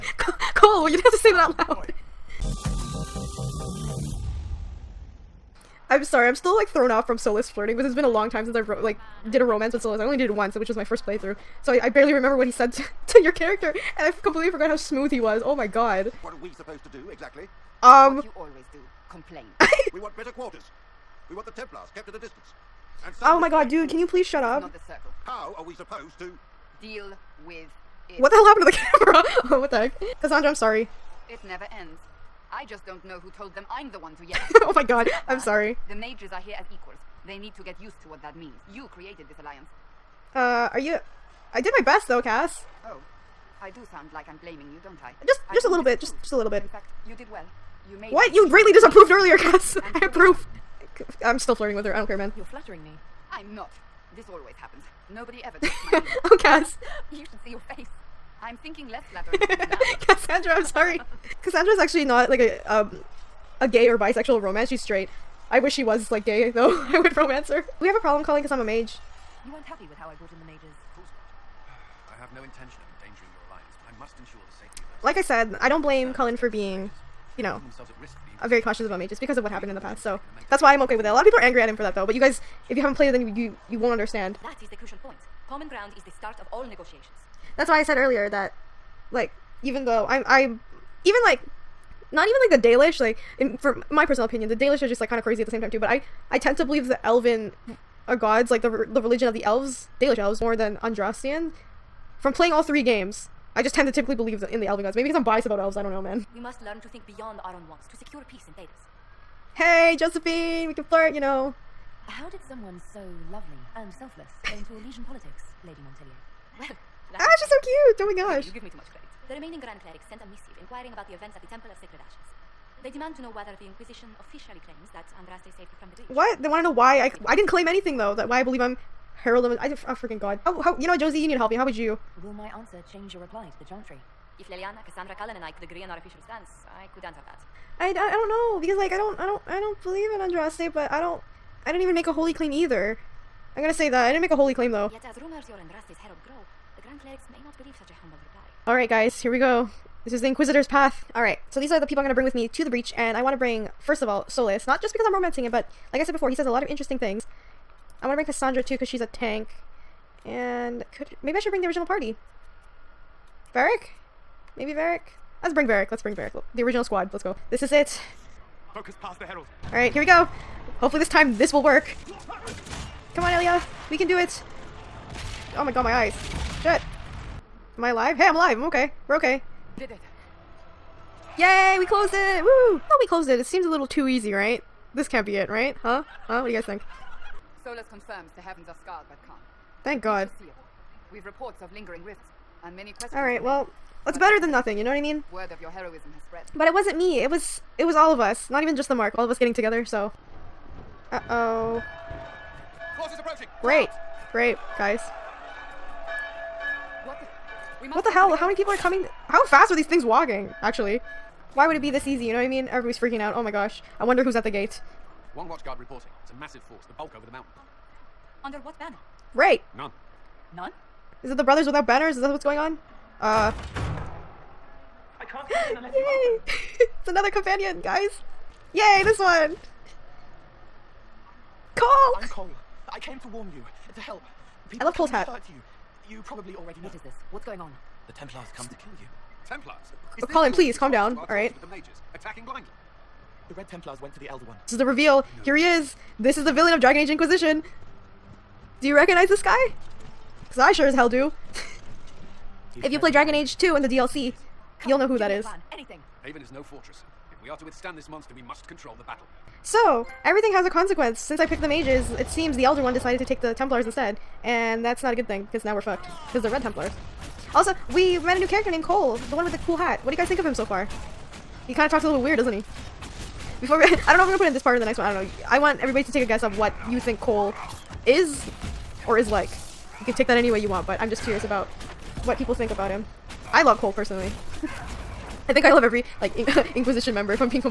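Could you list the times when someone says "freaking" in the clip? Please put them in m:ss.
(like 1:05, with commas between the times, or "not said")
2:09, 3:32.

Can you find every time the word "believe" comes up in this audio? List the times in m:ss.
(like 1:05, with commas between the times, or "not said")
1:36, 1:44, 2:08, 2:19, 2:27.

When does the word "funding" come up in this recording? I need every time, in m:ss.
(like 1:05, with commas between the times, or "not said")
not said.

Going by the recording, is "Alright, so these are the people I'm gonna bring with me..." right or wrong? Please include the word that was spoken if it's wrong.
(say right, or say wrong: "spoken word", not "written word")
right.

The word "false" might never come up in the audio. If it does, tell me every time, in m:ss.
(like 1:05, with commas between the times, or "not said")
not said.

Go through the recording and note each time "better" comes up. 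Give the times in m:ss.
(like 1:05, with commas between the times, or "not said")
0:20, 3:14.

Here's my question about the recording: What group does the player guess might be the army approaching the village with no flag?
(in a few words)
Brothers Without Banners.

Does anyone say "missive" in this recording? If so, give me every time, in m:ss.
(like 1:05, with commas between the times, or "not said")
2:00.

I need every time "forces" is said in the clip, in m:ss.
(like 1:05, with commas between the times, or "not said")
3:22, 3:36.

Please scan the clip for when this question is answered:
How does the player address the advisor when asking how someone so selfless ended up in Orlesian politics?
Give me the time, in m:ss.
1:55.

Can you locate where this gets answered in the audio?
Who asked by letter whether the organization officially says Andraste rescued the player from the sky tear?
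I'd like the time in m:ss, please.
1:59.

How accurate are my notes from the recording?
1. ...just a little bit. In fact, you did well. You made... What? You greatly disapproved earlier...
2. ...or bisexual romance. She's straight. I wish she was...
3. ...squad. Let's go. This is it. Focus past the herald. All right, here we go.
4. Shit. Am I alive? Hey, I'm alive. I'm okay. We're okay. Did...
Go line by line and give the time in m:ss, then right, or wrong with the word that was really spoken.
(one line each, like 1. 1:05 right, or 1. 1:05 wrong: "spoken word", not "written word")
1. 0:46 right
2. 1:03 right
3. 2:46 right
4. 2:56 right.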